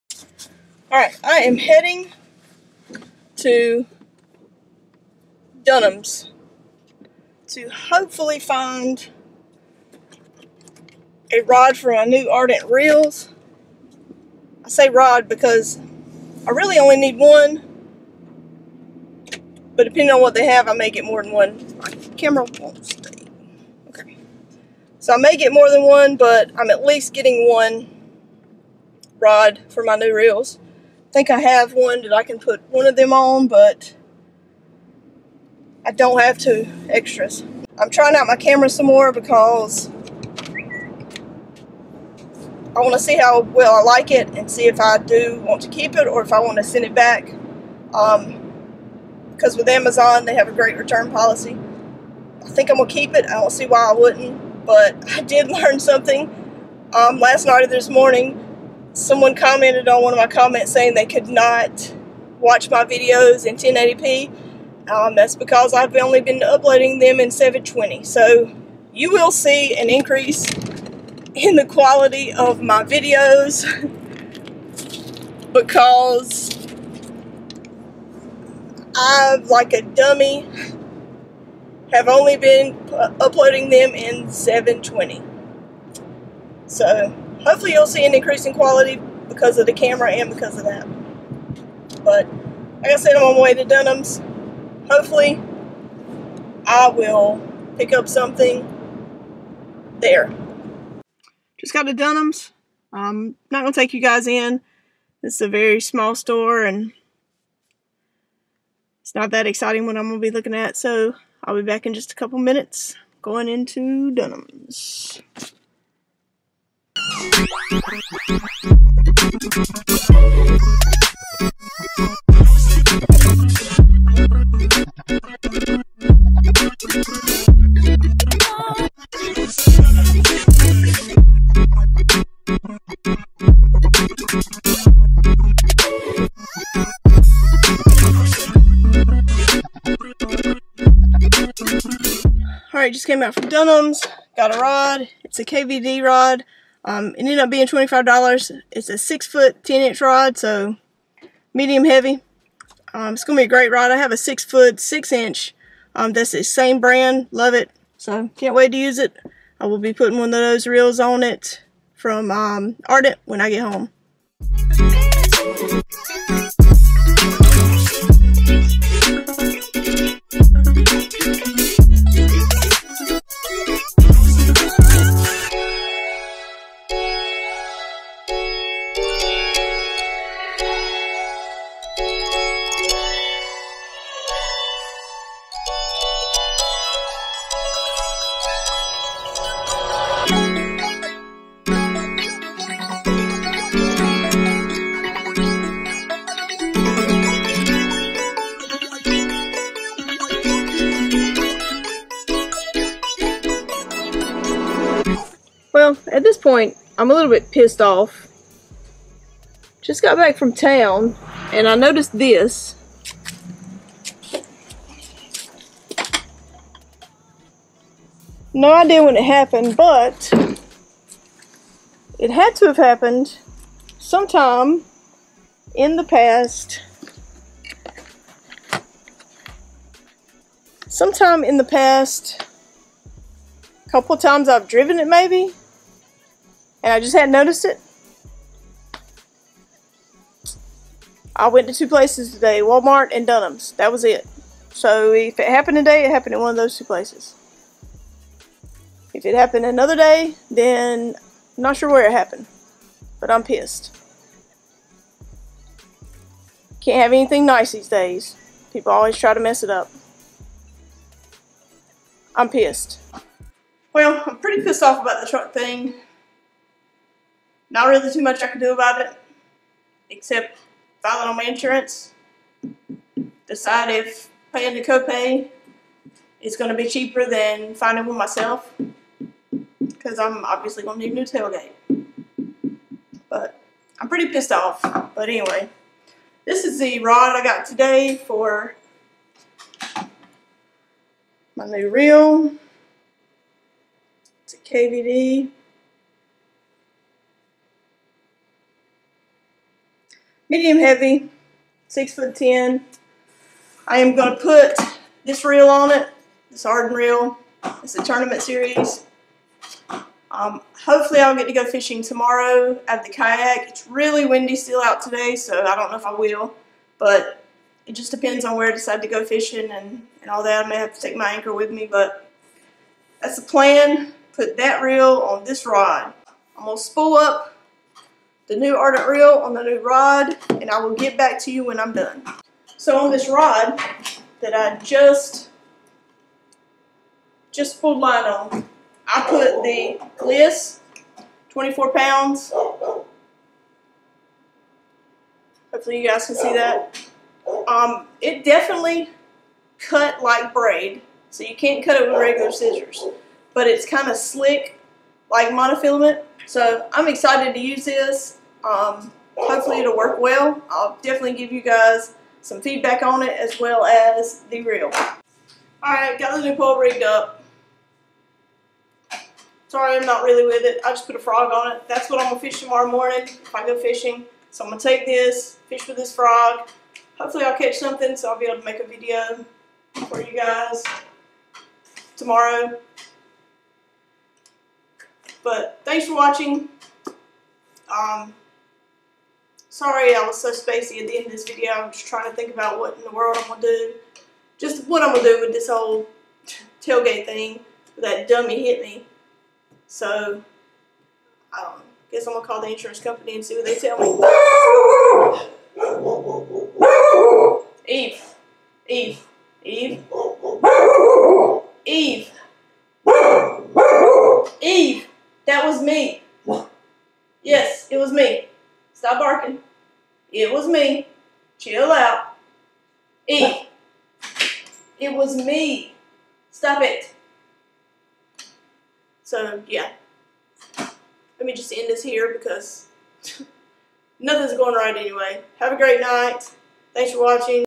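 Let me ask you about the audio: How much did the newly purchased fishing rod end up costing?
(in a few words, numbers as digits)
$25.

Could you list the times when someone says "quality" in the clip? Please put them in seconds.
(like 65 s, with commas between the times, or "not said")
71 s, 88 s.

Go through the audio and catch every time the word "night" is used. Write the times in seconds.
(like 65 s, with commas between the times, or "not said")
57 s, 436 s.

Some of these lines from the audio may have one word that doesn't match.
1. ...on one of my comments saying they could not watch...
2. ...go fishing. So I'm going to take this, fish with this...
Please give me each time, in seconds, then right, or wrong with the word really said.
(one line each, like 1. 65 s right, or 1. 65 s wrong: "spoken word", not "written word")
1. 59 s right
2. 373 s right.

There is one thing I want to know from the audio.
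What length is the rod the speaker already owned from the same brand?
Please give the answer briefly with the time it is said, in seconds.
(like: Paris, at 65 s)
6 foot 6 inch, at 154 s.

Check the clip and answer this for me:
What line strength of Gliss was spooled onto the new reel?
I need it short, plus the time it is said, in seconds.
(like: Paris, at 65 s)
24 pounds, at 341 s.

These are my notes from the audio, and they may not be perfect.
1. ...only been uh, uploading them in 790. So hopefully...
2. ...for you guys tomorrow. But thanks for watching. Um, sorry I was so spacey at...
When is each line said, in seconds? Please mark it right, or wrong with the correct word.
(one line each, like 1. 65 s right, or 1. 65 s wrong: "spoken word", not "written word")
1. 82 s wrong: "720", not "790"
2. 380 s right.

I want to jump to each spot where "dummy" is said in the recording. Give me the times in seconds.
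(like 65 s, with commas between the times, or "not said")
79 s, 398 s.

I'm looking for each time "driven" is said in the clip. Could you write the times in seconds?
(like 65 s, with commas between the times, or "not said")
234 s.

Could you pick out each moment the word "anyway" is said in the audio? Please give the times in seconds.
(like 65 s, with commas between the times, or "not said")
285 s, 434 s.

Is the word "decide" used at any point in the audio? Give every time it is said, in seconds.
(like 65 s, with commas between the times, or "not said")
273 s, 318 s.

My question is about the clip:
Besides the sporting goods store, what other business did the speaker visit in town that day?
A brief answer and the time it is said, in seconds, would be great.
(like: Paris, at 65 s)
Walmart, at 242 s.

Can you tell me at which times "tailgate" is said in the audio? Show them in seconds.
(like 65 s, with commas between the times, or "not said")
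281 s, 396 s.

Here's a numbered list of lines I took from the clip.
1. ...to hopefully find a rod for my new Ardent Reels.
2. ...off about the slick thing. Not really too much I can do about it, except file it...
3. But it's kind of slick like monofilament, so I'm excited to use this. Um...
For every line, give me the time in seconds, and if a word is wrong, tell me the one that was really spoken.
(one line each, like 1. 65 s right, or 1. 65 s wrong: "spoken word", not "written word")
1. 7 s right
2. 264 s wrong: "truck", not "slick"
3. 353 s right.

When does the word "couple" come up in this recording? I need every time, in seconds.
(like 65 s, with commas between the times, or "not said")
112 s, 233 s.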